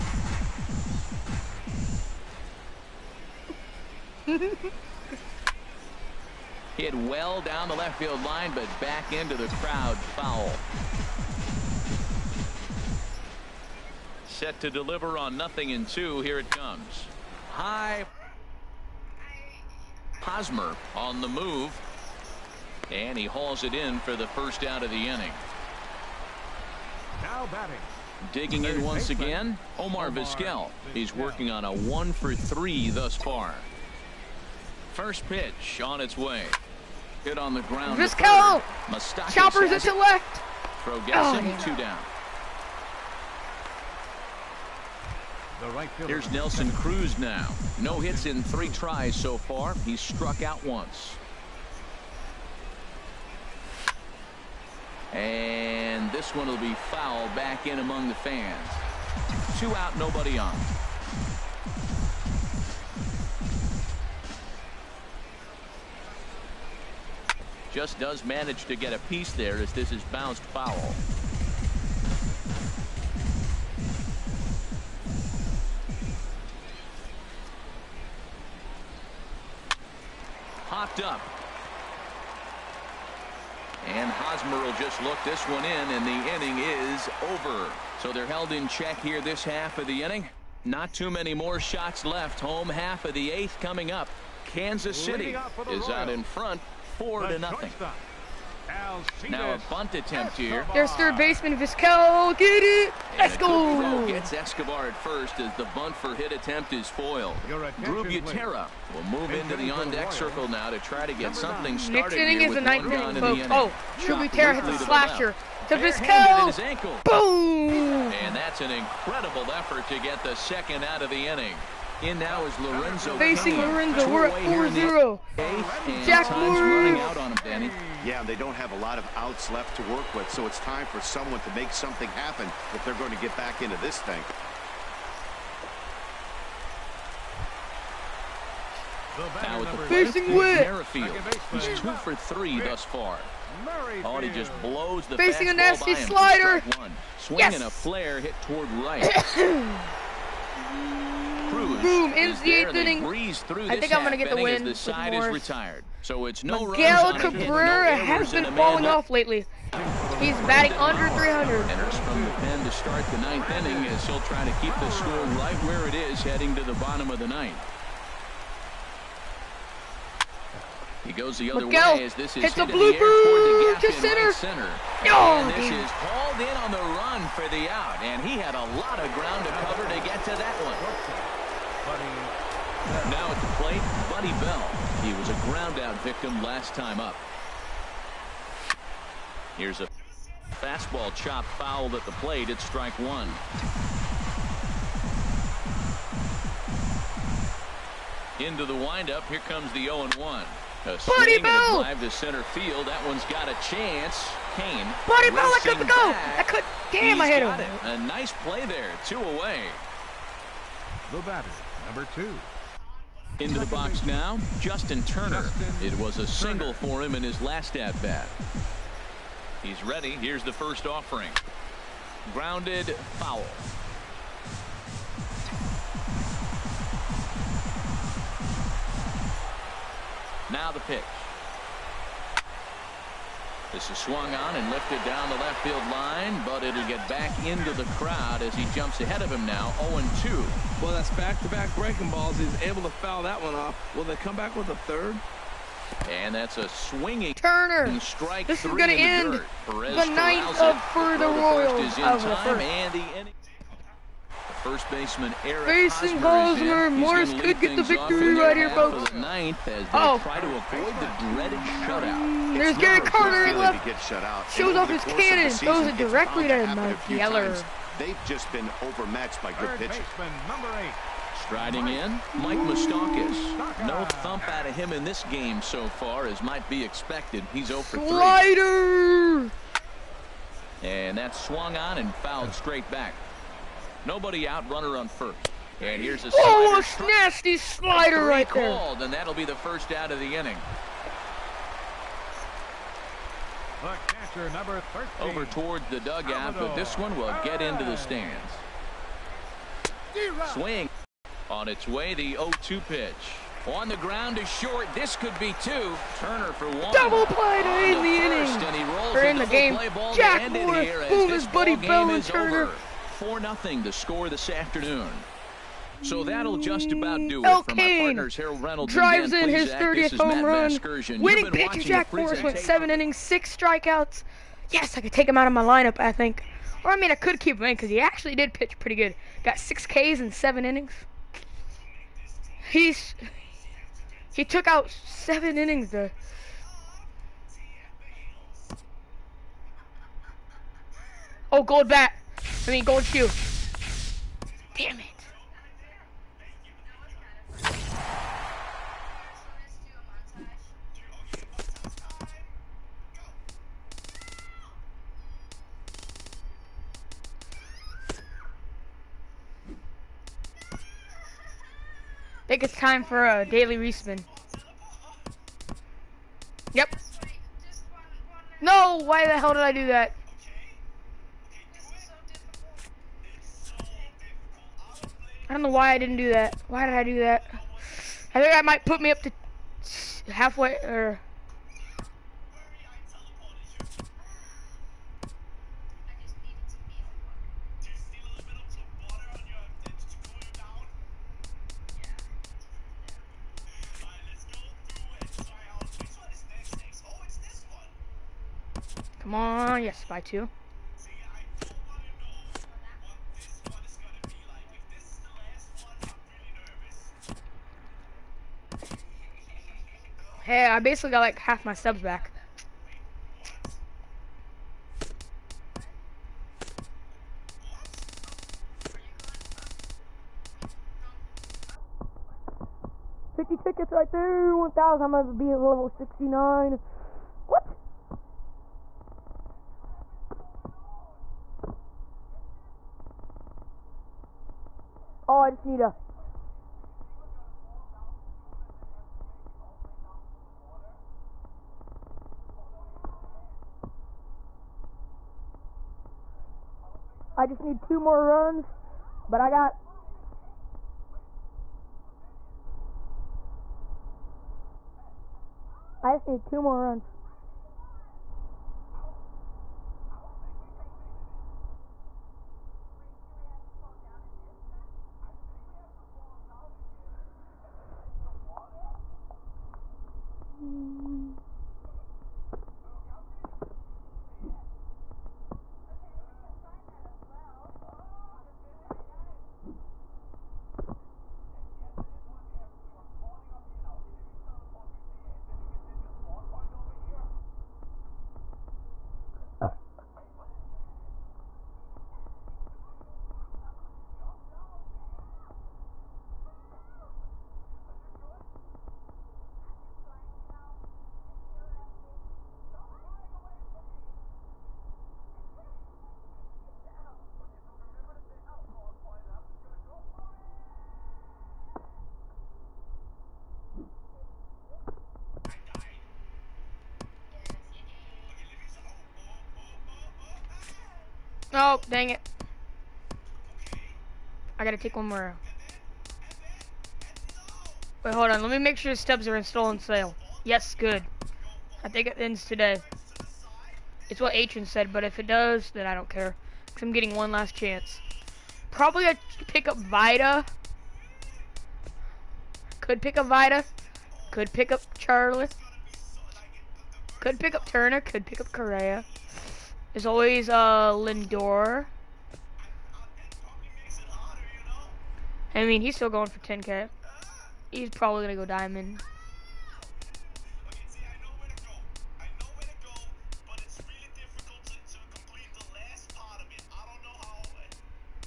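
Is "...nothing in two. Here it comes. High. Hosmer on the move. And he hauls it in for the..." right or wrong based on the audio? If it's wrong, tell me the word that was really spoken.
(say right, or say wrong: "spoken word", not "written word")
right.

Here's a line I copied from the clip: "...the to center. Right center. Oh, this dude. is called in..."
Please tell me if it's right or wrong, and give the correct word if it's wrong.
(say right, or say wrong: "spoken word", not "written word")
right.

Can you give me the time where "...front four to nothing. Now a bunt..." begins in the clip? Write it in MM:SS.
01:36.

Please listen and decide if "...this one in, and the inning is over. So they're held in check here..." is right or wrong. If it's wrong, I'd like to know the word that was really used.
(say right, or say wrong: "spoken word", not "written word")
right.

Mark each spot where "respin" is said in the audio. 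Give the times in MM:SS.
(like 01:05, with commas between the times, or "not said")
06:03.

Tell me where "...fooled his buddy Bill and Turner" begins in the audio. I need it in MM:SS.
05:11.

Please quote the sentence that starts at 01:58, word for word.
And that's an incredible effort to get the second out of the inning.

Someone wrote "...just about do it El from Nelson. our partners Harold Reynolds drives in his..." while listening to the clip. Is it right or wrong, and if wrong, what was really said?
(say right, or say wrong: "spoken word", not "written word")
wrong: "Cain", not "Nelson".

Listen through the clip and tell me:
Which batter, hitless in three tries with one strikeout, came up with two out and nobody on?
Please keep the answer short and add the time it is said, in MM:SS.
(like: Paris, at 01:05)
Nelson Cruz, at 00:46.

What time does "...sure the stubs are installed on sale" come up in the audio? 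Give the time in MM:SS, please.
08:48.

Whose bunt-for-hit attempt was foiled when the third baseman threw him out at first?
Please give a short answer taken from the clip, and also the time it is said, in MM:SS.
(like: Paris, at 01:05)
Escobar, at 01:44.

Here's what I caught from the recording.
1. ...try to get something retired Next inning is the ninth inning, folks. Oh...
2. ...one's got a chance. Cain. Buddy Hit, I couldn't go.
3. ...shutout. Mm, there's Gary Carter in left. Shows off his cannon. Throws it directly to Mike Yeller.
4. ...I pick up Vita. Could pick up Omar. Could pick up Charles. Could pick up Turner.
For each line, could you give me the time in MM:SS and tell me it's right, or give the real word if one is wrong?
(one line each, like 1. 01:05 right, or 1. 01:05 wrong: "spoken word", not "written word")
1. 01:50 wrong: "started", not "retired"
2. 03:23 wrong: "Bell", not "Hit"
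3. 04:21 right
4. 08:59 wrong: "Vita", not "Omar".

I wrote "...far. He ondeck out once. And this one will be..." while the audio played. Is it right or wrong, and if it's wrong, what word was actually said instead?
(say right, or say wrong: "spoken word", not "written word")
wrong: "struck", not "ondeck".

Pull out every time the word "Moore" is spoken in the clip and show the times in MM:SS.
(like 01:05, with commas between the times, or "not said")
02:06, 05:10.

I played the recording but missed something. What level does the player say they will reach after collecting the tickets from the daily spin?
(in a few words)
69.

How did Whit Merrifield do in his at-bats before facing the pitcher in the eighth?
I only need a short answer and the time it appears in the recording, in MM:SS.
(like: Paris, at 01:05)
2 for 3, at 02:21.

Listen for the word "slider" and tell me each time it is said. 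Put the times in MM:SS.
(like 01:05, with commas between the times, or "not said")
02:25, 04:38, 04:47.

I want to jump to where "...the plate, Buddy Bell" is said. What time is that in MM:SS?
03:03.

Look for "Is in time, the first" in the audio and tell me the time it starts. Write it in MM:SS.
04:11.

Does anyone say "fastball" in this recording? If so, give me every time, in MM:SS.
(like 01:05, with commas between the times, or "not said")
03:10.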